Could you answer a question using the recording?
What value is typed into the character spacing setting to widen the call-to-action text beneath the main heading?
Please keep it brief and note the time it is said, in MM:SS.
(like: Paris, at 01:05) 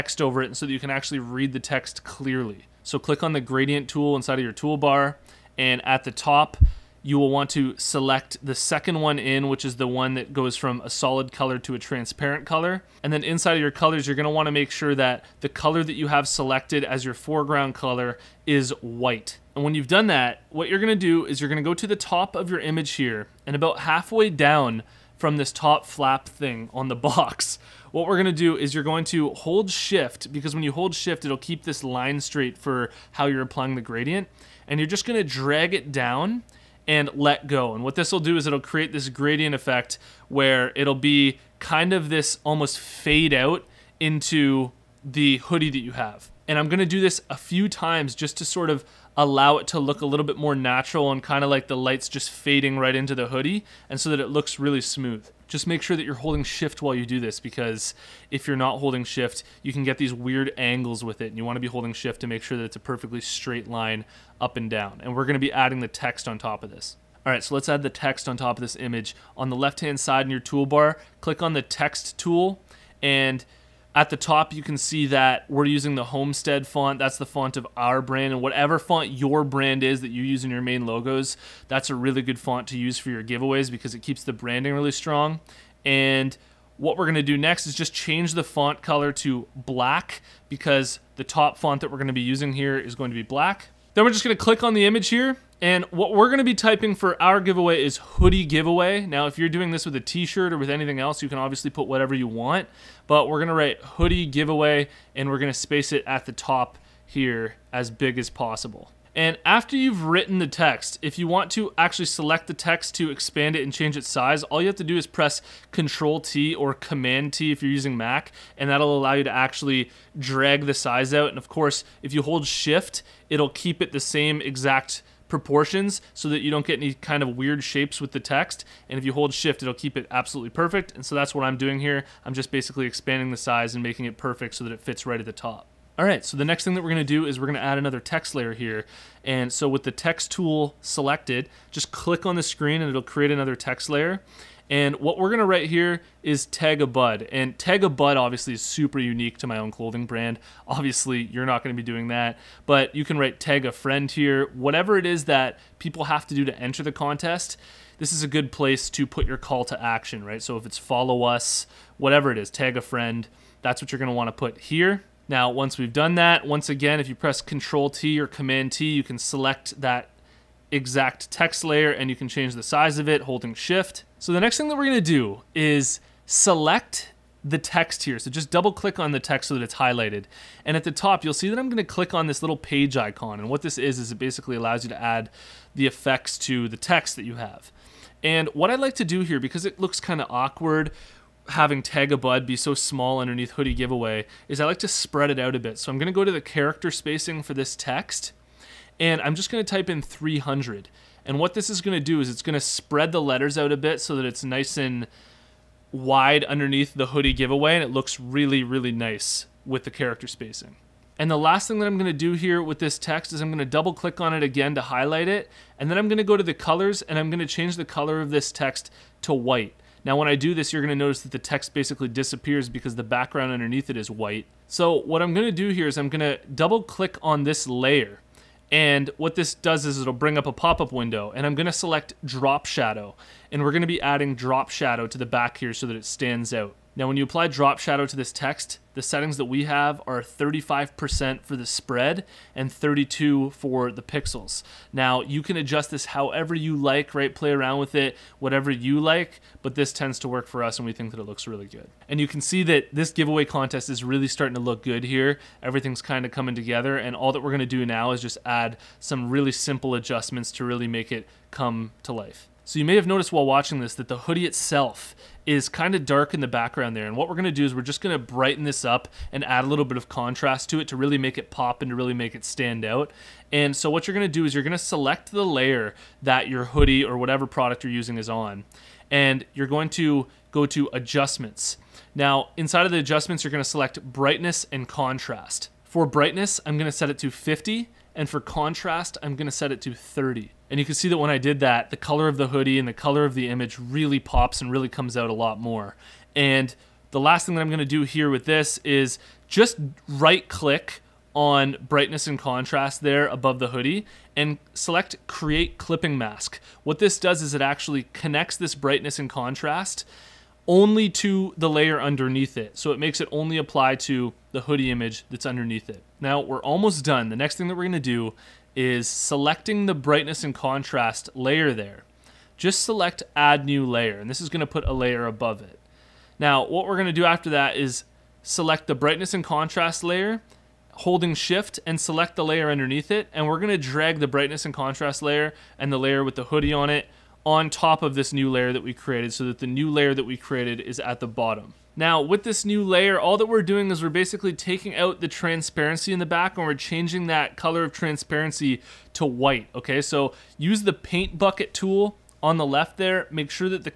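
300, at 03:20.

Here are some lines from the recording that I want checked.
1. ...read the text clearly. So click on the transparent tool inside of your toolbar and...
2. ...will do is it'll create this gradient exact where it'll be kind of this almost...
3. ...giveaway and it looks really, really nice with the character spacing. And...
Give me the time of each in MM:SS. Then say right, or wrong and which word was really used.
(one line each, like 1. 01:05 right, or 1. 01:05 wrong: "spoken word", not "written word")
1. 00:01 wrong: "gradient", not "transparent"
2. 00:38 wrong: "effect", not "exact"
3. 03:27 right.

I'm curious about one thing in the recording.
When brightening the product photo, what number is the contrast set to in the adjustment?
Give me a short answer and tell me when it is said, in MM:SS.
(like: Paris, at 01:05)
30, at 04:49.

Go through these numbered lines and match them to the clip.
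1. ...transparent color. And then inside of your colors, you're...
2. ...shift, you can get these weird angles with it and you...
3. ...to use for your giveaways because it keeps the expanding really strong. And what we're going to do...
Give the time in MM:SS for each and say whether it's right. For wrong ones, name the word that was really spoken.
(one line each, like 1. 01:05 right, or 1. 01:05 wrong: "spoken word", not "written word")
1. 00:11 right
2. 00:59 right
3. 01:22 wrong: "branding", not "expanding".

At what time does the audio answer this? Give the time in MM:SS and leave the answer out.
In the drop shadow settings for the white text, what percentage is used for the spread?
04:00.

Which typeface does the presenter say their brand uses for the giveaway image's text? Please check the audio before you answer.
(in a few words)
Homestead.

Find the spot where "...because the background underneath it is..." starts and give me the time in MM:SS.
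03:42.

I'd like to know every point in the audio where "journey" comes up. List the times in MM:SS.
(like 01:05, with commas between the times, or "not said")
not said.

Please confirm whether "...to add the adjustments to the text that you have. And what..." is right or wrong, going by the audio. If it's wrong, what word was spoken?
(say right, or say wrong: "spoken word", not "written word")
wrong: "effects", not "adjustments".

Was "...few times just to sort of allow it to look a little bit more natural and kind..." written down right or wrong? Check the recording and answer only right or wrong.
right.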